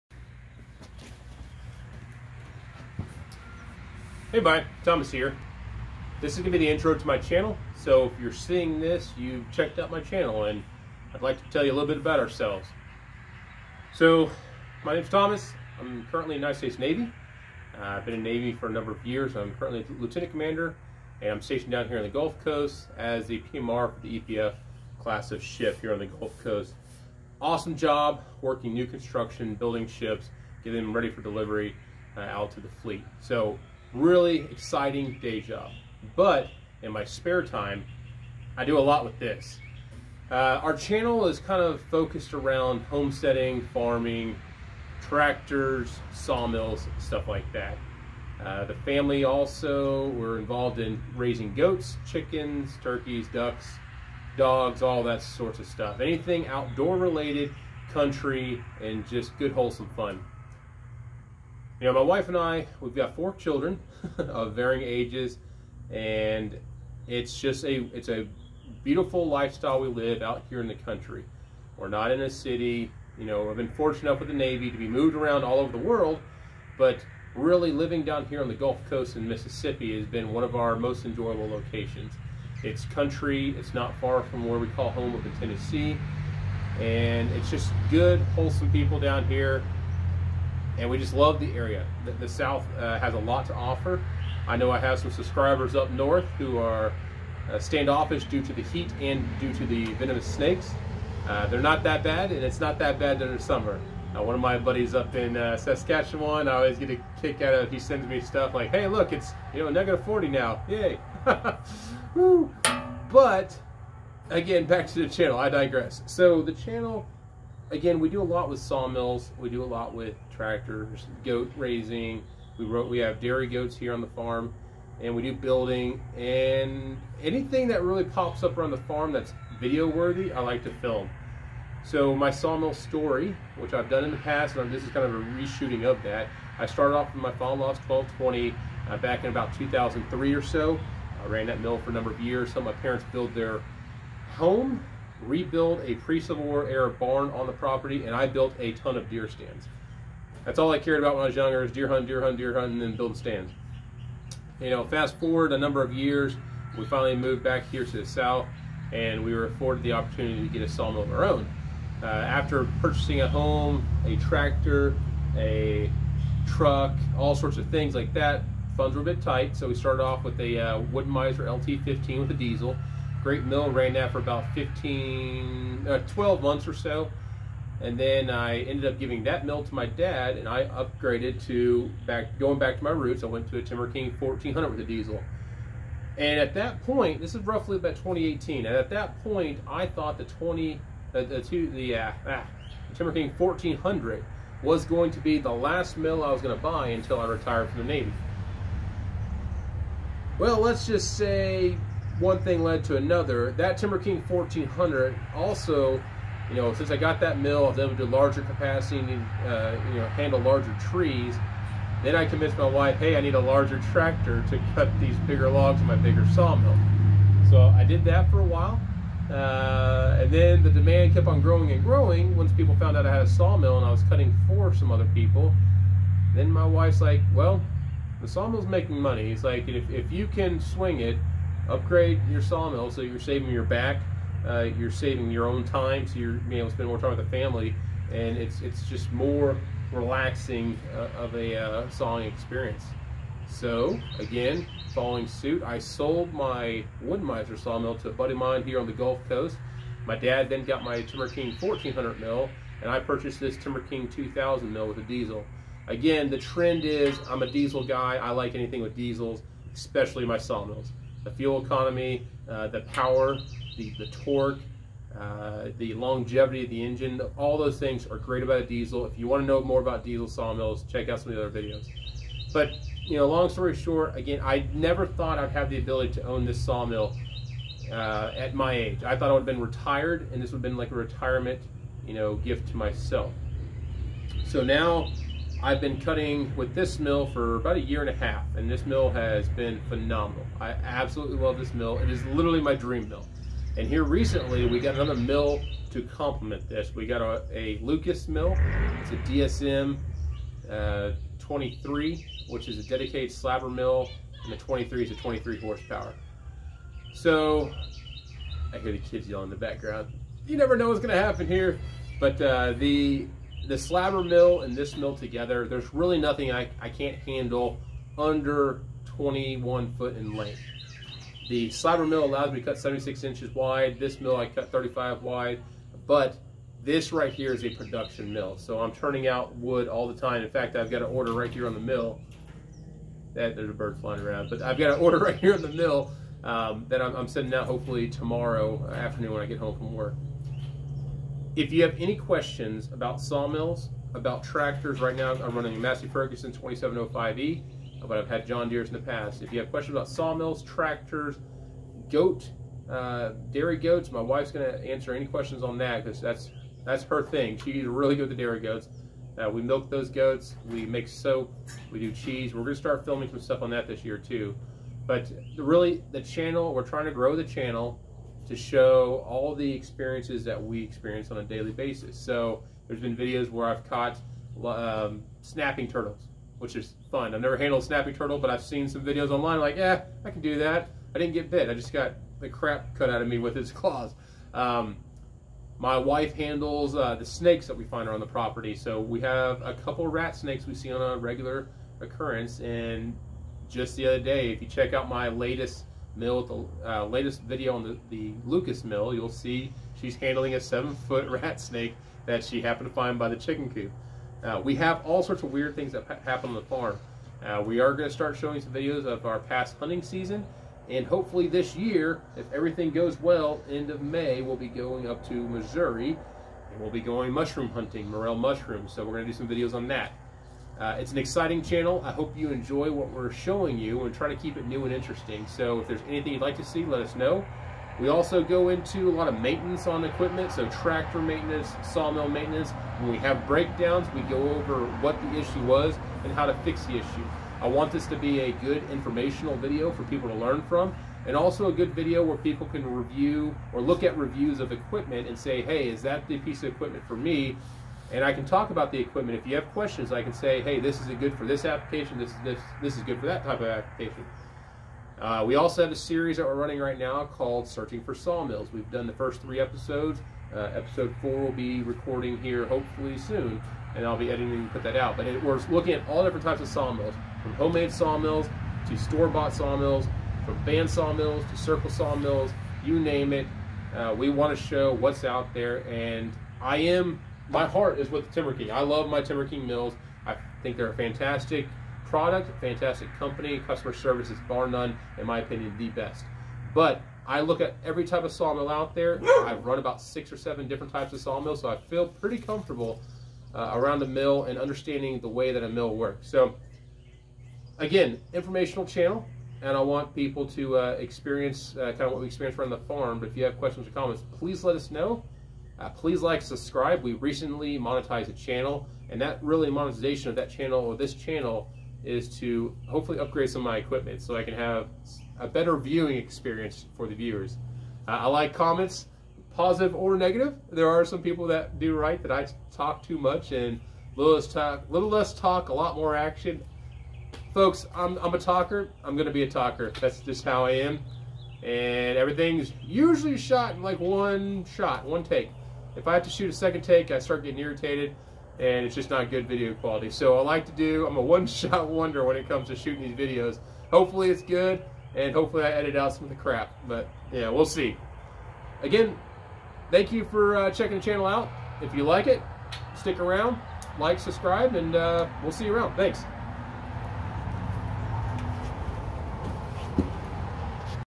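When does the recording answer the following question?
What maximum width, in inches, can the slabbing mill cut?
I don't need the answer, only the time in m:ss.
5:22.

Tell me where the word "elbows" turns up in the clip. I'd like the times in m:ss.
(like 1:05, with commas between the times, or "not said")
not said.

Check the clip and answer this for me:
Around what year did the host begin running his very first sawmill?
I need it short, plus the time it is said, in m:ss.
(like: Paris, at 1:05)
2003, at 2:19.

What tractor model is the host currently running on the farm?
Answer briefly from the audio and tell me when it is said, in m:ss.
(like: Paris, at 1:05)
Massey Ferguson 2705E, at 5:45.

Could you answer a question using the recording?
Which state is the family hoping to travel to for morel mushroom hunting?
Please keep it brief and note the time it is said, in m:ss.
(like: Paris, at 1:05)
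Missouri, at 6:55.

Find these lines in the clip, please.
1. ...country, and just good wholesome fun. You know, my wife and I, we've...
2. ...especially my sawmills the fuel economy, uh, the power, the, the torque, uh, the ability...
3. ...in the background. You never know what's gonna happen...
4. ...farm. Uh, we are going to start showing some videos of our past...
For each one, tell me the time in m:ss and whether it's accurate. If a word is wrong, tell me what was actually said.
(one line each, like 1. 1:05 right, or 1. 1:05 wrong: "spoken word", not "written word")
1. 0:57 right
2. 4:19 wrong: "longevity", not "ability"
3. 5:09 right
4. 6:46 right.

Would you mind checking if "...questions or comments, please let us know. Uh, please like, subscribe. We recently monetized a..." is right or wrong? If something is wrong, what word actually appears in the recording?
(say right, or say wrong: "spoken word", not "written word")
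right.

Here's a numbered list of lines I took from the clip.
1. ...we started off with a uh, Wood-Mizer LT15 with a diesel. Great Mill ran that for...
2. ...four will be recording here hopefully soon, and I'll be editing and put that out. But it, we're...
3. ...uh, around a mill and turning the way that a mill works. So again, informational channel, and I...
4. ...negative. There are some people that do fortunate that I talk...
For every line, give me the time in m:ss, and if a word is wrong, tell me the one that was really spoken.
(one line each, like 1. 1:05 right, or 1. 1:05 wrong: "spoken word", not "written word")
1. 2:49 right
2. 7:41 right
3. 8:13 wrong: "understanding", not "turning"
4. 8:40 wrong: "write", not "fortunate".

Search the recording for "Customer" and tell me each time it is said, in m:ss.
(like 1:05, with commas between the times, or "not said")
8:03.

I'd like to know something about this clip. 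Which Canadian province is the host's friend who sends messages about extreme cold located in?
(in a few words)
Saskatchewan.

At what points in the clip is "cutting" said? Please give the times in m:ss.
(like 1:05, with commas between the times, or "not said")
3:44, 4:46.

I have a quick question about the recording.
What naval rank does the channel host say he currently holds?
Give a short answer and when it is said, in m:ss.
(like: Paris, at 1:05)
Lieutenant Commander, at 0:19.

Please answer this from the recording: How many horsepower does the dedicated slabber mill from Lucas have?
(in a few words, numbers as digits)
23.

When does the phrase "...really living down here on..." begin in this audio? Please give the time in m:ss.
1:17.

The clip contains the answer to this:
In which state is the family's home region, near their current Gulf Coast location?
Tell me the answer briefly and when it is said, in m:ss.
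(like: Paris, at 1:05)
Tennessee, at 1:25.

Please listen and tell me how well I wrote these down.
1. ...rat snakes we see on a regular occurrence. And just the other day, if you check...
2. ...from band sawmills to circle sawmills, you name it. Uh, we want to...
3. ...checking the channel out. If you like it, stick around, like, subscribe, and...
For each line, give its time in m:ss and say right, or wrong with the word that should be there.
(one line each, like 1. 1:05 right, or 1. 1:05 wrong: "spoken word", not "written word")
1. 6:30 right
2. 7:50 right
3. 9:10 right.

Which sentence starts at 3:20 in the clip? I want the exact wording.
Well, let's just say one thing led to another.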